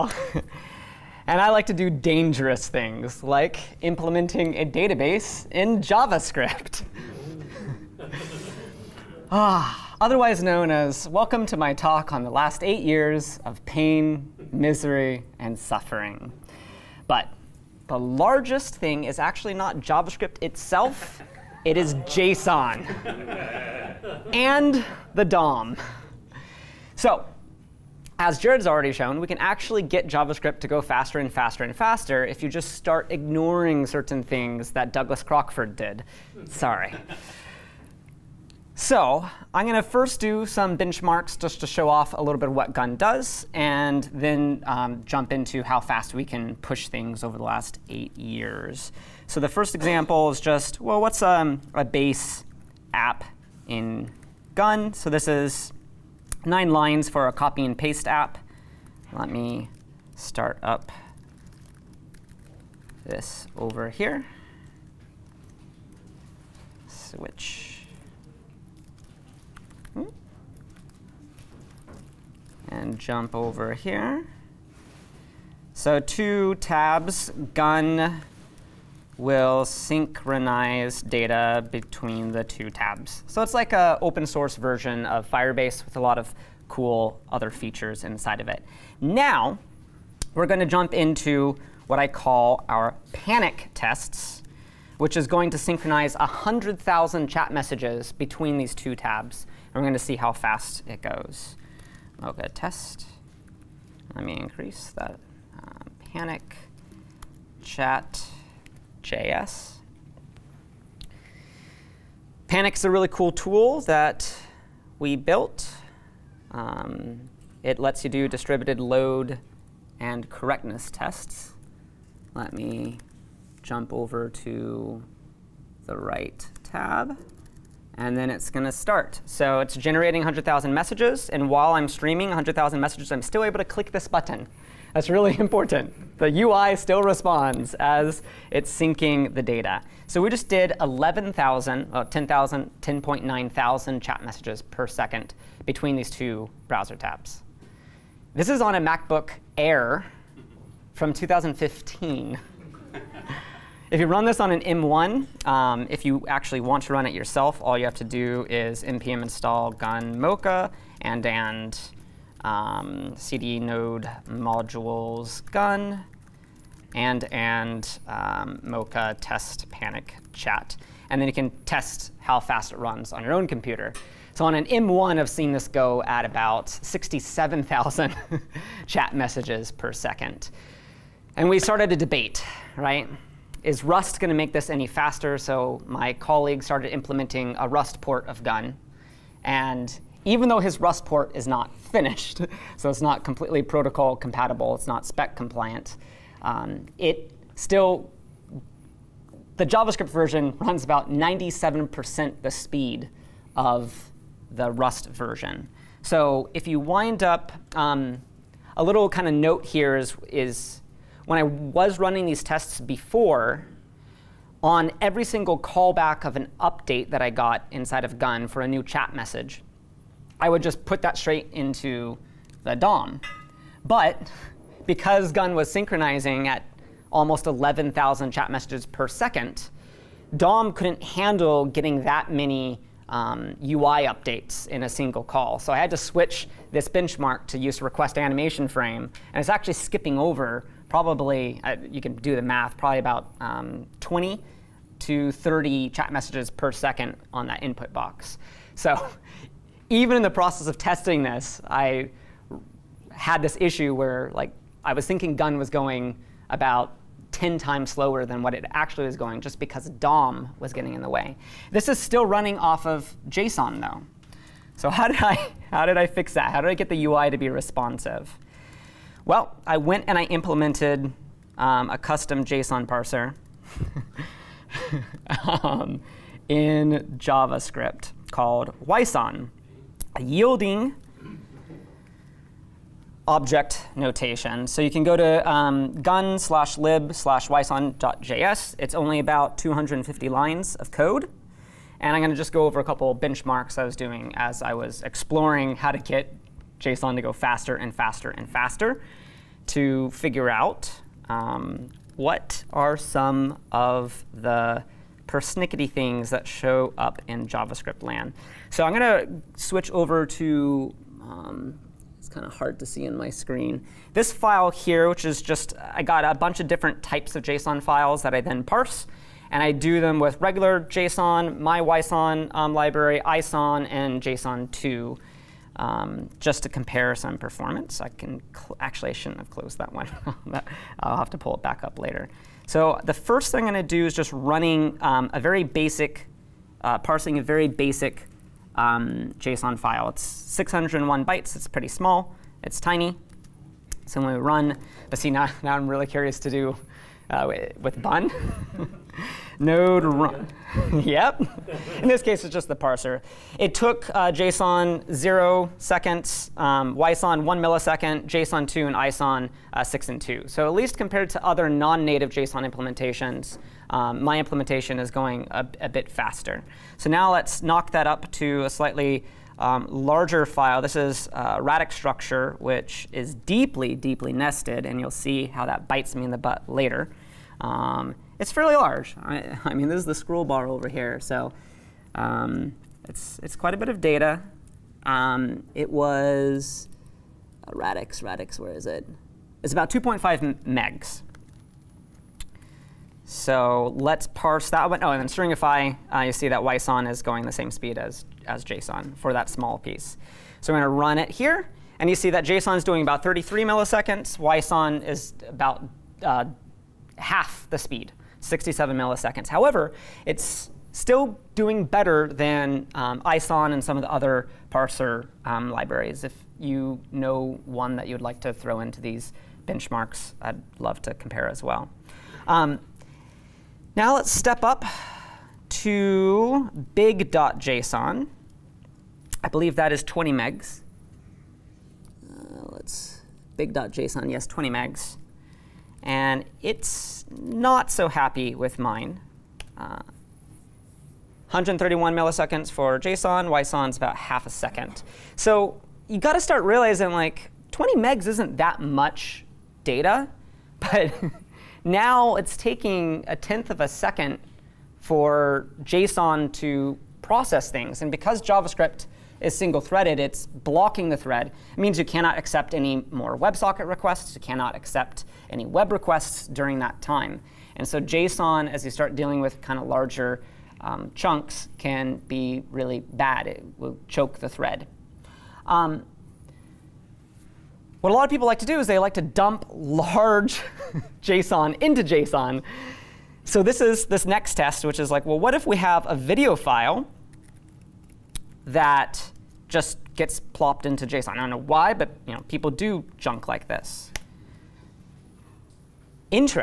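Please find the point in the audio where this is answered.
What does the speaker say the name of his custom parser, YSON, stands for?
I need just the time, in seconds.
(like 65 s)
280 s.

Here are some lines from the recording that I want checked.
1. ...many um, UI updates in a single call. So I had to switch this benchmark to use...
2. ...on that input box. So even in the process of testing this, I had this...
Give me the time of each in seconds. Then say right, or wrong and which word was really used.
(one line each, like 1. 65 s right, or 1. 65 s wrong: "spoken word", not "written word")
1. 232 s right
2. 247 s right.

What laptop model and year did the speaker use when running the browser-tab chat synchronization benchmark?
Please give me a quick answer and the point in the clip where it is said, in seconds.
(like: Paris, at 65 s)
MacBook Air from 2015, at 148 s.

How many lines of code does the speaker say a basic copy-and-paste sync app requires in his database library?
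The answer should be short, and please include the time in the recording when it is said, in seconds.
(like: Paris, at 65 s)
9, at 56 s.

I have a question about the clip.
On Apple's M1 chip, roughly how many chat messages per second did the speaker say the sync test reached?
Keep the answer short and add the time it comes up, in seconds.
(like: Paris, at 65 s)
67,000, at 176 s.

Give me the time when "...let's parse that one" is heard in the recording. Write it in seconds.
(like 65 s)
393 s.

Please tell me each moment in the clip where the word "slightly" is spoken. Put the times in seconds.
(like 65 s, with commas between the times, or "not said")
368 s.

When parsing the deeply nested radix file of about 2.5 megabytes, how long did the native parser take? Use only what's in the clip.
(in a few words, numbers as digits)
33 milliseconds.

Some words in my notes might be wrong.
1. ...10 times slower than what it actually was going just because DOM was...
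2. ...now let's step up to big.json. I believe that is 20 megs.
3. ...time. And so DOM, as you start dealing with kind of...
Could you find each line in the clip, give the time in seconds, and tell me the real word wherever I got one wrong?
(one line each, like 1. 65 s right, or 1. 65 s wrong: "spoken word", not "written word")
1. 257 s right
2. 423 s right
3. 467 s wrong: "JSON", not "DOM".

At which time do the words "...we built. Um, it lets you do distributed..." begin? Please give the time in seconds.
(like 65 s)
114 s.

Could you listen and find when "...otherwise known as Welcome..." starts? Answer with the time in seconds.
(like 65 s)
9 s.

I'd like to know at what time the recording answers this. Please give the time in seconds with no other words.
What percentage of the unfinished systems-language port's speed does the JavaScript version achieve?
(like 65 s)
201 s.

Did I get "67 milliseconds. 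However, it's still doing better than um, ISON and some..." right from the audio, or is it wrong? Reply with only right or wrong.
right.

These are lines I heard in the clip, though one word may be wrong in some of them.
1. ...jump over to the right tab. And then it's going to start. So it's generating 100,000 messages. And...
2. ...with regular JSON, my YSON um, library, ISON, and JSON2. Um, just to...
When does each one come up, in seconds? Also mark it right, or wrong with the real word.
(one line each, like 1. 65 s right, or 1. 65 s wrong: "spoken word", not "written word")
1. 123 s right
2. 320 s right.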